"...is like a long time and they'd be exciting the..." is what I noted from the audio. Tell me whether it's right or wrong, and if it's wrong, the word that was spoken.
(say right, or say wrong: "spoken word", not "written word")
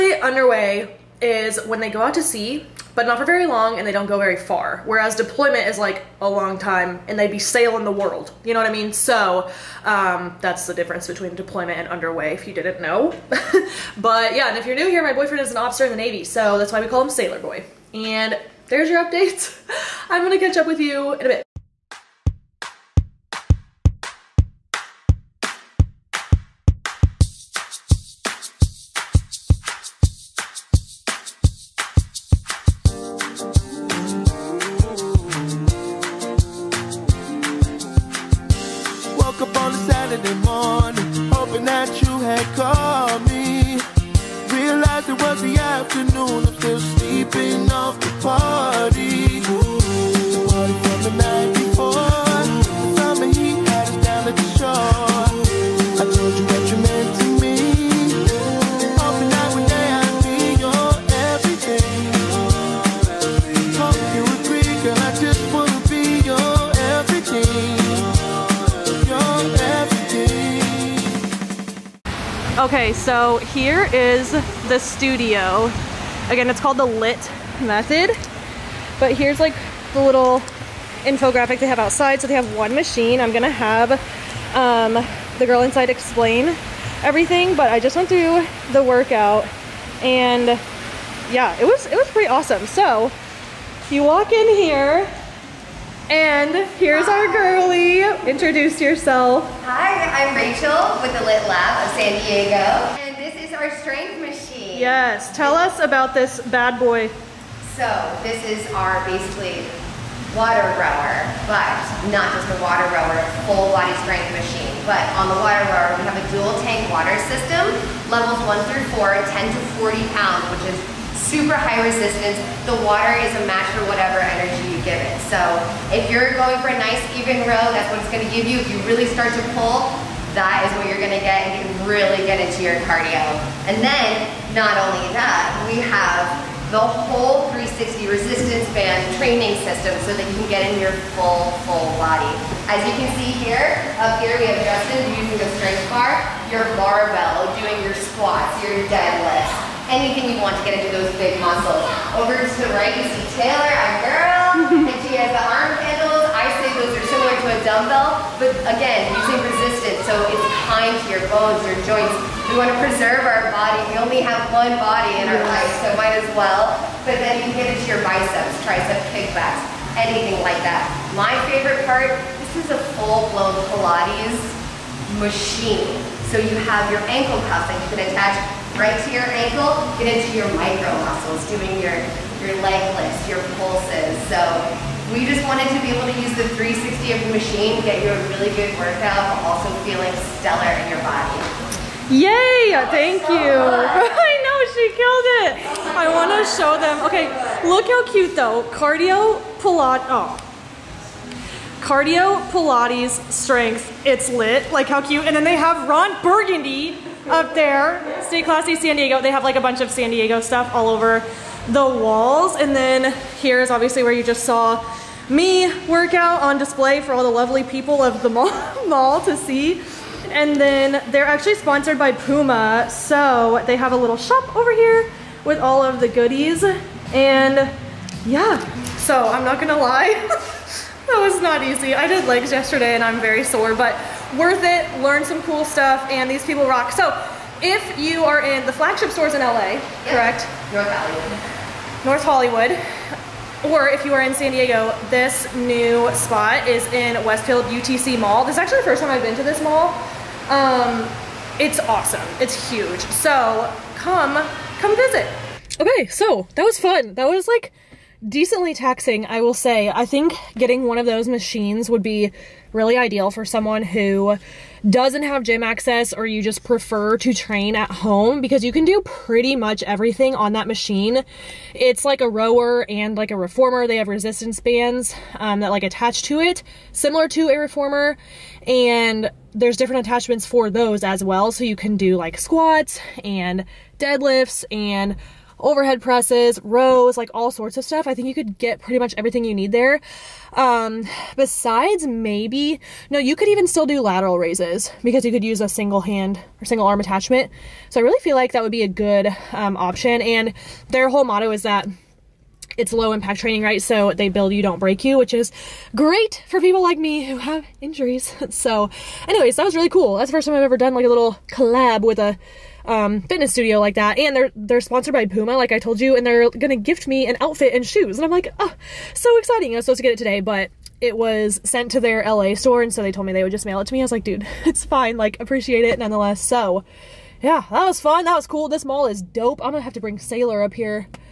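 wrong: "sailing", not "exciting".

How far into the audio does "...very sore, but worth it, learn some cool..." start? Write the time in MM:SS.
03:53.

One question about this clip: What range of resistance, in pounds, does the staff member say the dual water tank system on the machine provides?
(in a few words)
10 to 40 pounds.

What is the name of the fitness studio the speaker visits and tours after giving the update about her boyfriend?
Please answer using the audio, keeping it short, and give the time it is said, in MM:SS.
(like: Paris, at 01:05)
Lit Method, at 01:16.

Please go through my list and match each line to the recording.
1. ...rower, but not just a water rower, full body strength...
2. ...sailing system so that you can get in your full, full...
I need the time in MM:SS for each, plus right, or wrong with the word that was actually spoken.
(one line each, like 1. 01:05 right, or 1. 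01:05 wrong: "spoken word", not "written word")
1. 01:50 right
2. 02:19 wrong: "training", not "sailing".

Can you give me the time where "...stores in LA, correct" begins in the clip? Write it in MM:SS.
03:59.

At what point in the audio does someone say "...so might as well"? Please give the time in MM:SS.
02:45.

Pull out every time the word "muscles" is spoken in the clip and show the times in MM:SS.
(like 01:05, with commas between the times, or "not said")
02:31, 03:01.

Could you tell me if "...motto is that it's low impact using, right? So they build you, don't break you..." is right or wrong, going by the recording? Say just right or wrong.
wrong.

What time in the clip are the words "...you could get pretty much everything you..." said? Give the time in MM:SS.
04:48.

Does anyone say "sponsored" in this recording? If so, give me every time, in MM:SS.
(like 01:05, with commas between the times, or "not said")
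03:41, 05:14.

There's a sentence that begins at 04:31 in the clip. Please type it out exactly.
It's like a rower and like a reformer.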